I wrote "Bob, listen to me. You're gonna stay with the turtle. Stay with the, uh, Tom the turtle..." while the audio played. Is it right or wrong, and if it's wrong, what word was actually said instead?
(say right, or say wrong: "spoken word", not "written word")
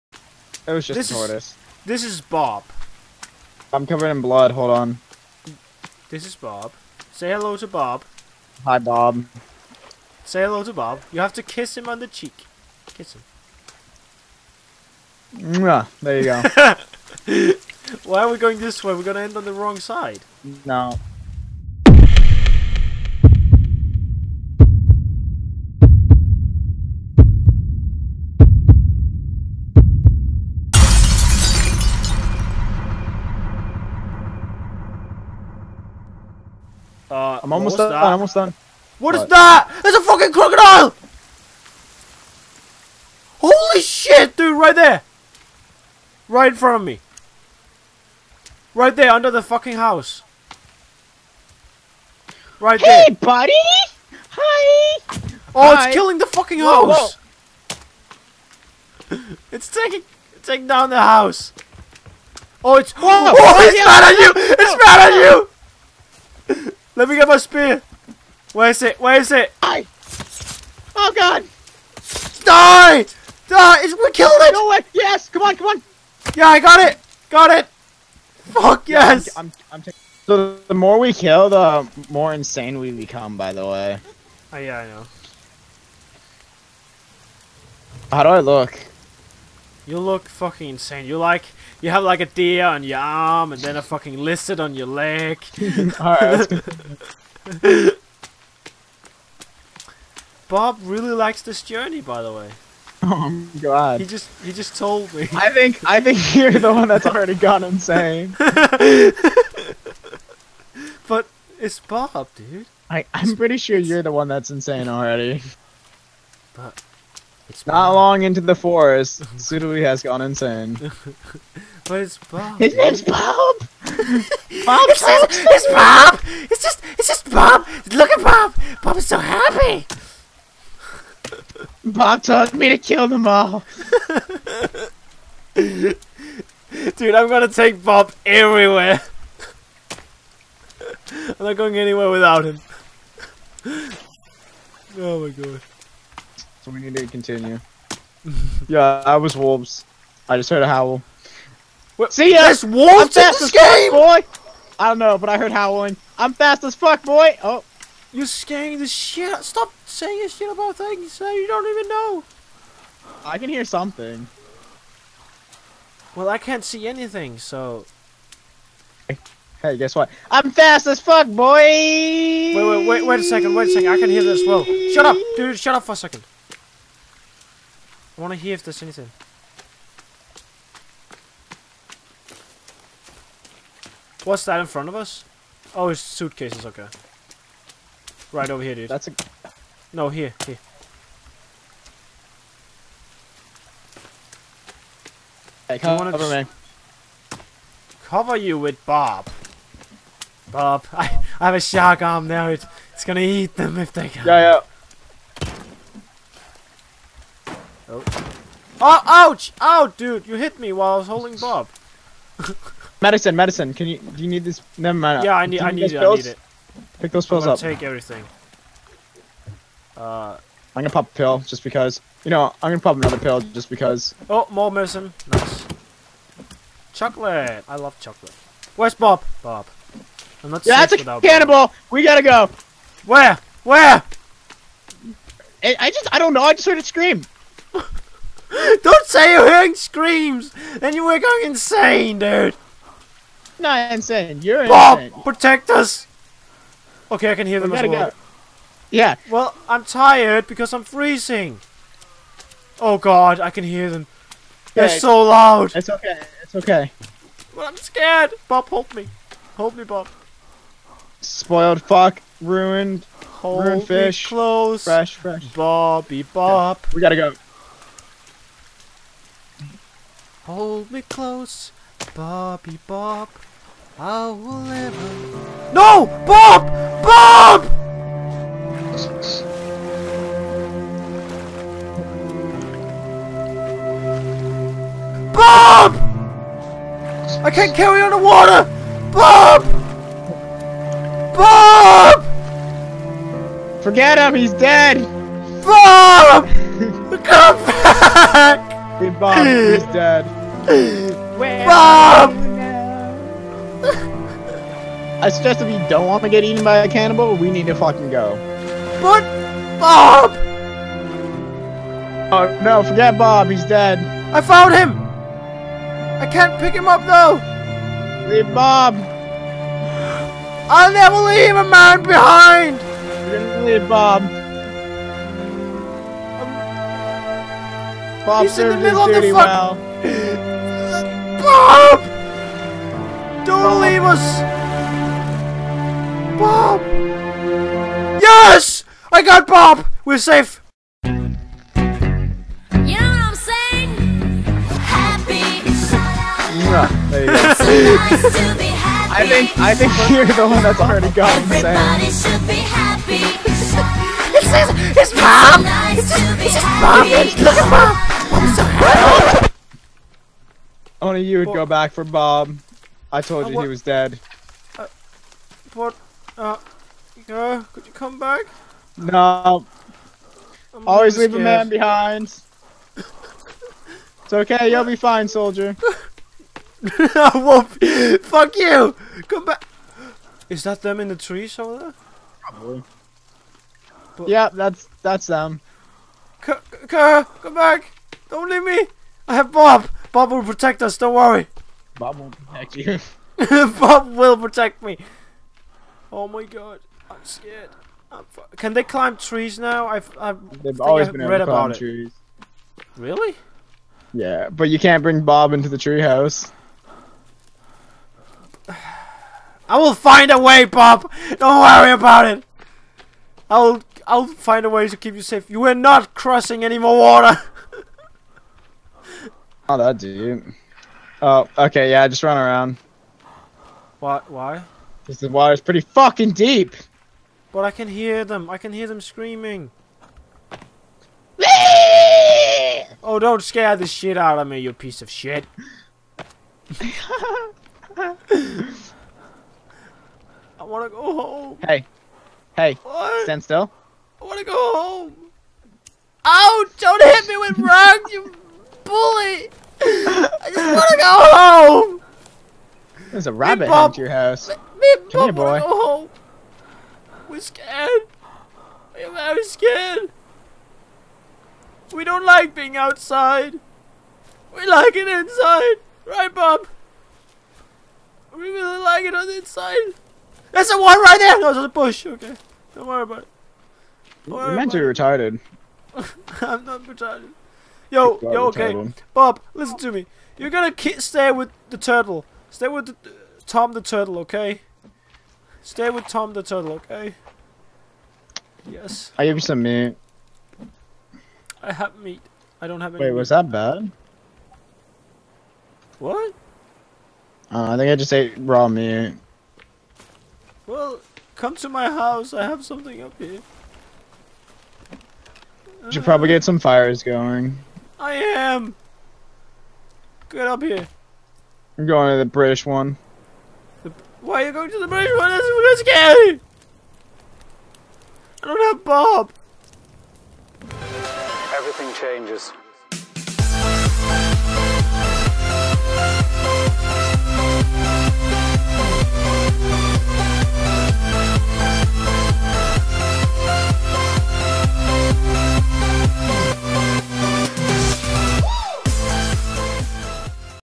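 right.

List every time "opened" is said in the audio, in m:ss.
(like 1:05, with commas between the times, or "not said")
not said.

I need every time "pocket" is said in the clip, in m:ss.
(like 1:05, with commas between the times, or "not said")
not said.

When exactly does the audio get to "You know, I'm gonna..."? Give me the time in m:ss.
3:42.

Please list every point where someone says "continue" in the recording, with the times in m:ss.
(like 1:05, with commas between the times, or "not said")
2:27.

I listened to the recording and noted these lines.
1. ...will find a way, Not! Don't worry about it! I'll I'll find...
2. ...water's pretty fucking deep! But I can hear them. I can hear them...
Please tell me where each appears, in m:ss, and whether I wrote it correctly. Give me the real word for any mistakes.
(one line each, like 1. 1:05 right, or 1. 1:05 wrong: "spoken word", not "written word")
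1. 6:49 wrong: "Bob", not "Not"
2. 7:05 right.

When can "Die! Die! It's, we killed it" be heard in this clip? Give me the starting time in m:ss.
1:12.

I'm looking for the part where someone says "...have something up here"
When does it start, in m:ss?
8:22.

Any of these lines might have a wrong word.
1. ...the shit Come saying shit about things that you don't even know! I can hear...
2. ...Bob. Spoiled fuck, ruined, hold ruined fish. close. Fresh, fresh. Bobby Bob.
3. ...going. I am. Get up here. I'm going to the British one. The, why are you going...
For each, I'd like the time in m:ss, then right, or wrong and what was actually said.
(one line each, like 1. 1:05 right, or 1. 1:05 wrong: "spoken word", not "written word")
1. 2:38 wrong: "Stop", not "Come"
2. 4:19 right
3. 8:27 right.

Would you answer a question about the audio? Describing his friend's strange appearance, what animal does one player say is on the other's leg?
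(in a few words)
Lizard.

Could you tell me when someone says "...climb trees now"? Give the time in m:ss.
6:38.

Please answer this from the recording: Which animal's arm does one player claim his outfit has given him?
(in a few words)
Shark.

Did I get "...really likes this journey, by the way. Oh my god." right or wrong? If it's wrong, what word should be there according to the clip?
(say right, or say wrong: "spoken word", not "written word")
right.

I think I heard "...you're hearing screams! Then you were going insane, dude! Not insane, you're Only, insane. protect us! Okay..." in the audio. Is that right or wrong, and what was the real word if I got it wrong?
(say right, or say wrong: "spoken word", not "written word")
wrong: "Bob", not "Only".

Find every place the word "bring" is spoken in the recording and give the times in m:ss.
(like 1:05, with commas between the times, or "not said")
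6:45.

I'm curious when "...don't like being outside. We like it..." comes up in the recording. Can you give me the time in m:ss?
7:42.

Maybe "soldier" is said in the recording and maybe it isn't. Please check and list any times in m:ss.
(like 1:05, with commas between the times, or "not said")
6:15, 6:21.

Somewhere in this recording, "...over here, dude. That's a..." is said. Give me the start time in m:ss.
3:08.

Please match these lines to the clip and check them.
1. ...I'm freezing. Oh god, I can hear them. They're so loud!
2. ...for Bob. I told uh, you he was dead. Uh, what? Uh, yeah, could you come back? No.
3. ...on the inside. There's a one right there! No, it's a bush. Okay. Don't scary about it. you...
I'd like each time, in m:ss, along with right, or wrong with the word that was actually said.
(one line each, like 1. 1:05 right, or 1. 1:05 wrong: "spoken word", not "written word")
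1. 4:10 right
2. 6:01 right
3. 7:49 wrong: "worry", not "scary".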